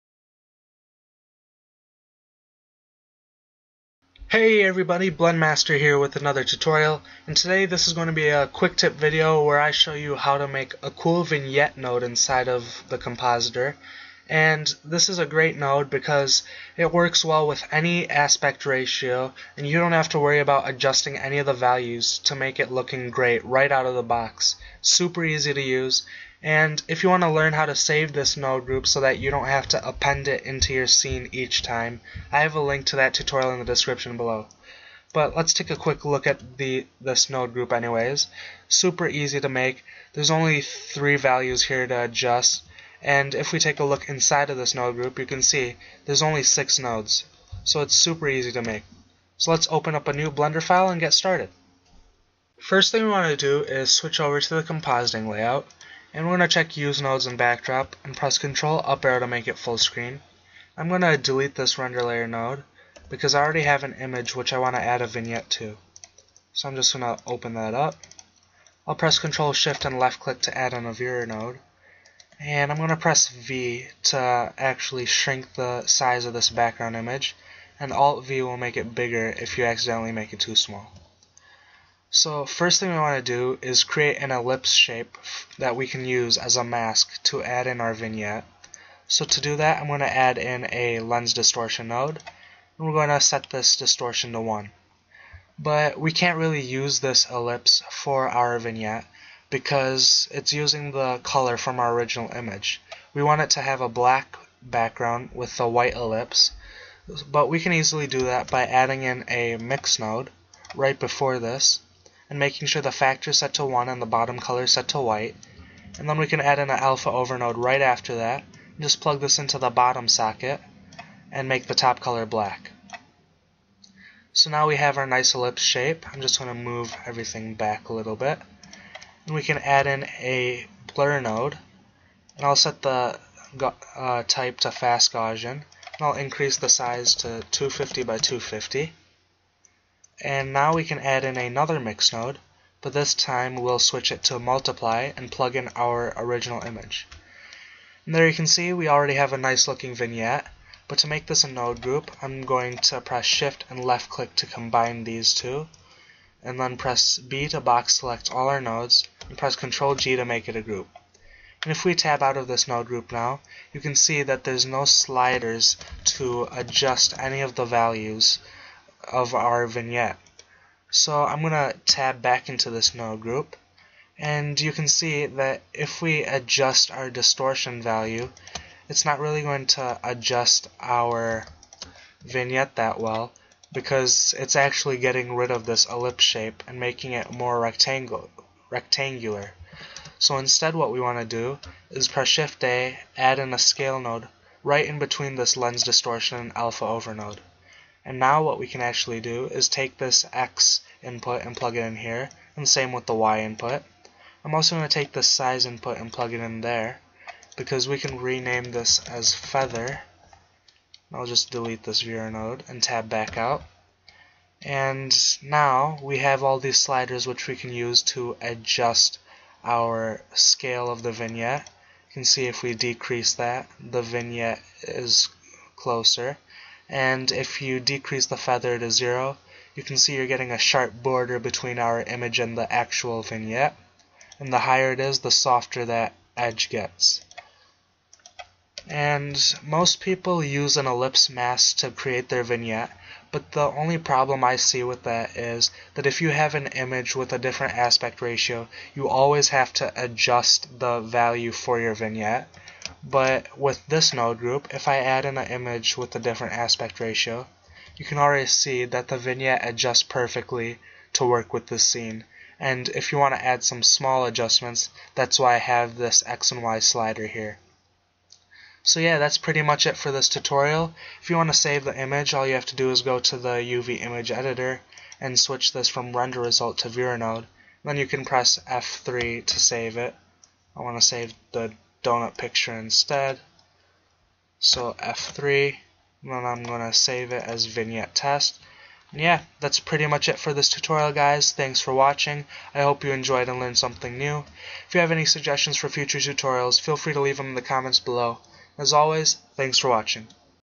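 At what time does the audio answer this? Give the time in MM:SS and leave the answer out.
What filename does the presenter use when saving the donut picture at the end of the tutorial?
04:47.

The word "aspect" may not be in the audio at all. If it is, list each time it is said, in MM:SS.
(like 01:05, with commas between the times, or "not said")
00:18, 04:07, 04:16.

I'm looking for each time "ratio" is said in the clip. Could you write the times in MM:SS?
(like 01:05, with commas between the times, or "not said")
00:18, 04:08, 04:16.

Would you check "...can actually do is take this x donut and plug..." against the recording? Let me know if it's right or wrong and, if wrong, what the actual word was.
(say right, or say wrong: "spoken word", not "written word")
wrong: "input", not "donut".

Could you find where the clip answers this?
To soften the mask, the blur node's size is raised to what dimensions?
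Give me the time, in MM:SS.
02:17.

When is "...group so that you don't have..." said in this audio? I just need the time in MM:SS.
00:28.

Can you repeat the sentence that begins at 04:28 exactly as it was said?
So yeah, that's pretty much it for this tutorial.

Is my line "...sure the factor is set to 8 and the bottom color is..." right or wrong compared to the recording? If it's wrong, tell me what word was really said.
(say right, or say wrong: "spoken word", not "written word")
wrong: "1", not "8".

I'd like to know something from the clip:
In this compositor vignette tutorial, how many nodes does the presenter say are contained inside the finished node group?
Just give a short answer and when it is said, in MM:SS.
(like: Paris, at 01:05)
6, at 00:46.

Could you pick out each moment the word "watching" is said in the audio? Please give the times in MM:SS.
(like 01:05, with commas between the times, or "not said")
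04:51, 04:59.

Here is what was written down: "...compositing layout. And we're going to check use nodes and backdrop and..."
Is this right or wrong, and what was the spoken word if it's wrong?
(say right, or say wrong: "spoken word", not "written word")
right.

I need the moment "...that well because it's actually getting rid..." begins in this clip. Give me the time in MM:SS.
03:02.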